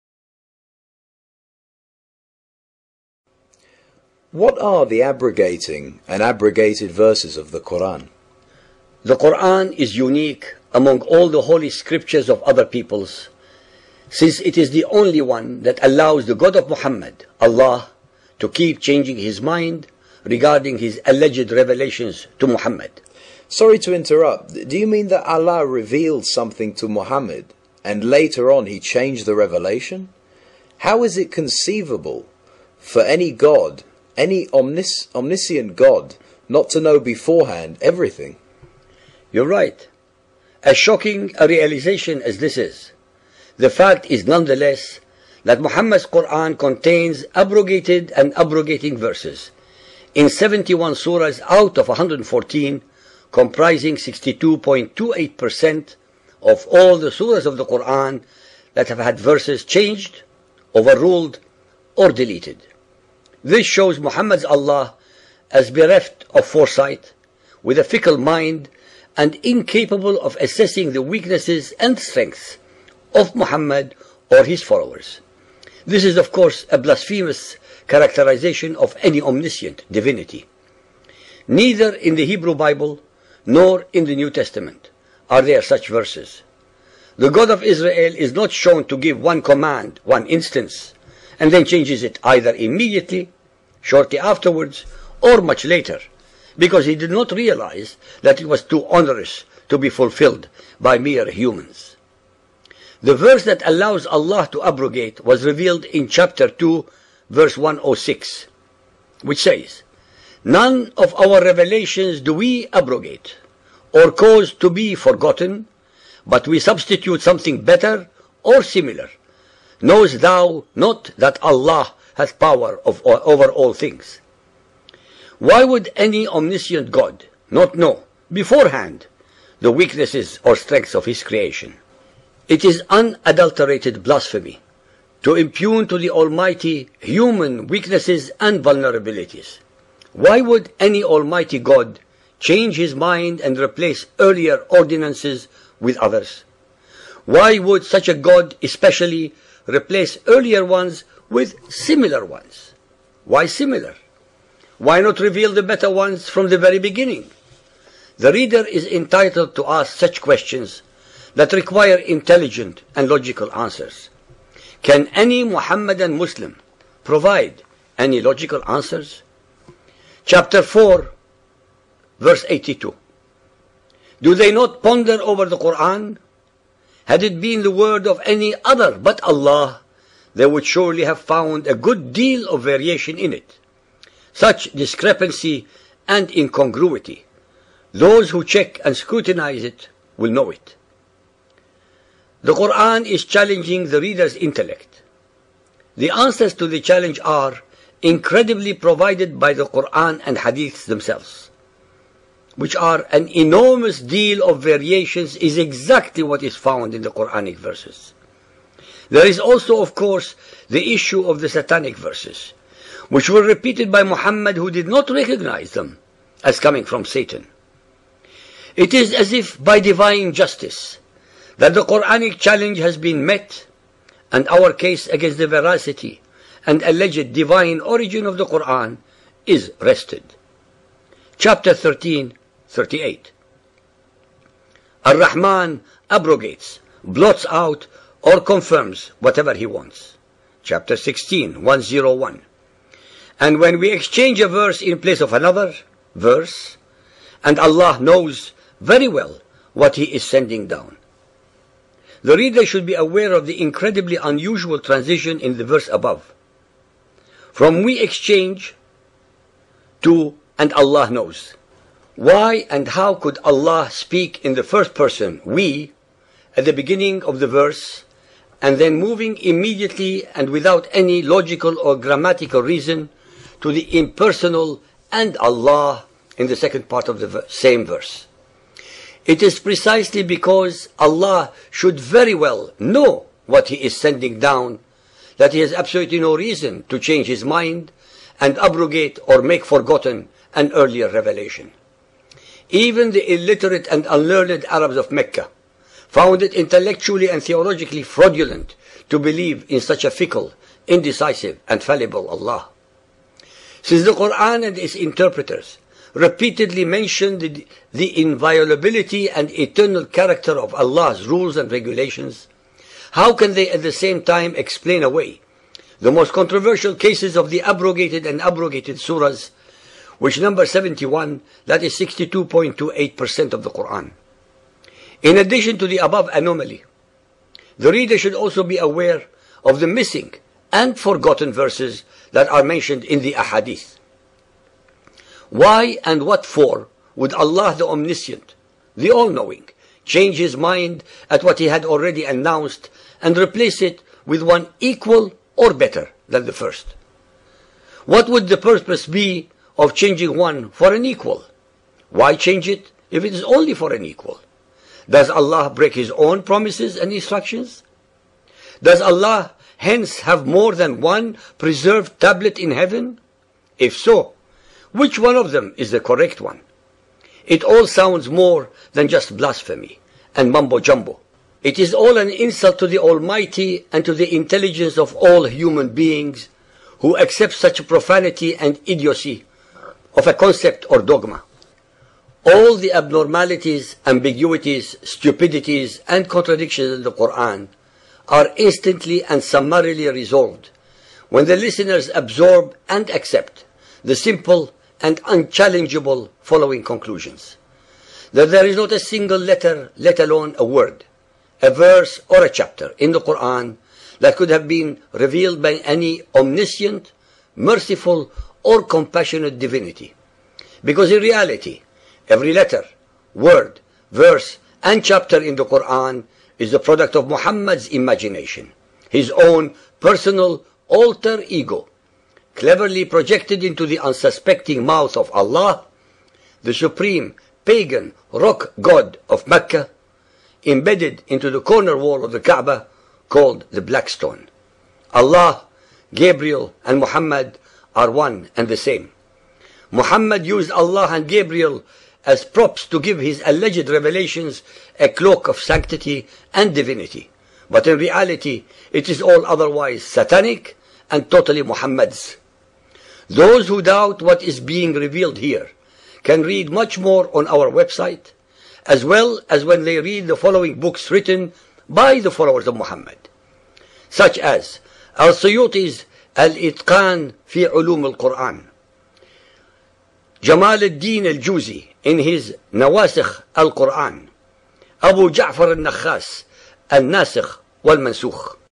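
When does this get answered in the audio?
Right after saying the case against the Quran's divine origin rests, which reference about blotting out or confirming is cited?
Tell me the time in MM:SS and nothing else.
03:51.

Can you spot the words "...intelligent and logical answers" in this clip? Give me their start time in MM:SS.
02:41.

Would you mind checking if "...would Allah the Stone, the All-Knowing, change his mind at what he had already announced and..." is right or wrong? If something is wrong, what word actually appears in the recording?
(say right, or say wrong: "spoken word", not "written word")
wrong: "Omniscient", not "Stone".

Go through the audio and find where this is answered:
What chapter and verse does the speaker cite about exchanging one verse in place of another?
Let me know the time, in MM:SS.
04:00.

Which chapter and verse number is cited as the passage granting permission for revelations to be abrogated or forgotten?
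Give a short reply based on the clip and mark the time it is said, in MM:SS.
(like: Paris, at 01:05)
Chapter 2, verse 106, at 01:46.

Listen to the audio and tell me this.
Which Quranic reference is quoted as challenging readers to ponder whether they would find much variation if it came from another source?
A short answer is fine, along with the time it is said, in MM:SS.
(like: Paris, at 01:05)
Chapter 4, verse 82, at 02:50.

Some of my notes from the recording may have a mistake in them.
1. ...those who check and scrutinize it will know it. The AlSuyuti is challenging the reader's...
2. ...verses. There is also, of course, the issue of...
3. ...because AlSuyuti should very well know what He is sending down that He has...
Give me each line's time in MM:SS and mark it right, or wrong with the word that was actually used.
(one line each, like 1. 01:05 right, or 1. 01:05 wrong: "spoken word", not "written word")
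1. 03:07 wrong: "Quran", not "AlSuyuti"
2. 03:27 right
3. 04:40 wrong: "Allah", not "AlSuyuti".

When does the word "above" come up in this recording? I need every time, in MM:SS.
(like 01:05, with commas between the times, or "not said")
04:15, 05:25.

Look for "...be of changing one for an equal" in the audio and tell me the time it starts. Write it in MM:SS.
05:49.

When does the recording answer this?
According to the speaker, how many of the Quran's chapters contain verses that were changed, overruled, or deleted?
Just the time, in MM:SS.
00:50.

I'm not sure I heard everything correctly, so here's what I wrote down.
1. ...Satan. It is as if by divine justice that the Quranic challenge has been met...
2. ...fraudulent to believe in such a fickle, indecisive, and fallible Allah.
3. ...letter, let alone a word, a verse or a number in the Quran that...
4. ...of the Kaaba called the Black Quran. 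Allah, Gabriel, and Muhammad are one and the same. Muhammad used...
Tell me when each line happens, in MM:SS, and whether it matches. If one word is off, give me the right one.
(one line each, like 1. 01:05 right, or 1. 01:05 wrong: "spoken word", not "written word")
1. 03:37 right
2. 04:58 right
3. 06:39 wrong: "chapter", not "number"
4. 07:12 wrong: "Stone", not "Quran".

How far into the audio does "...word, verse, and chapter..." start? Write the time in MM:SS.
06:53.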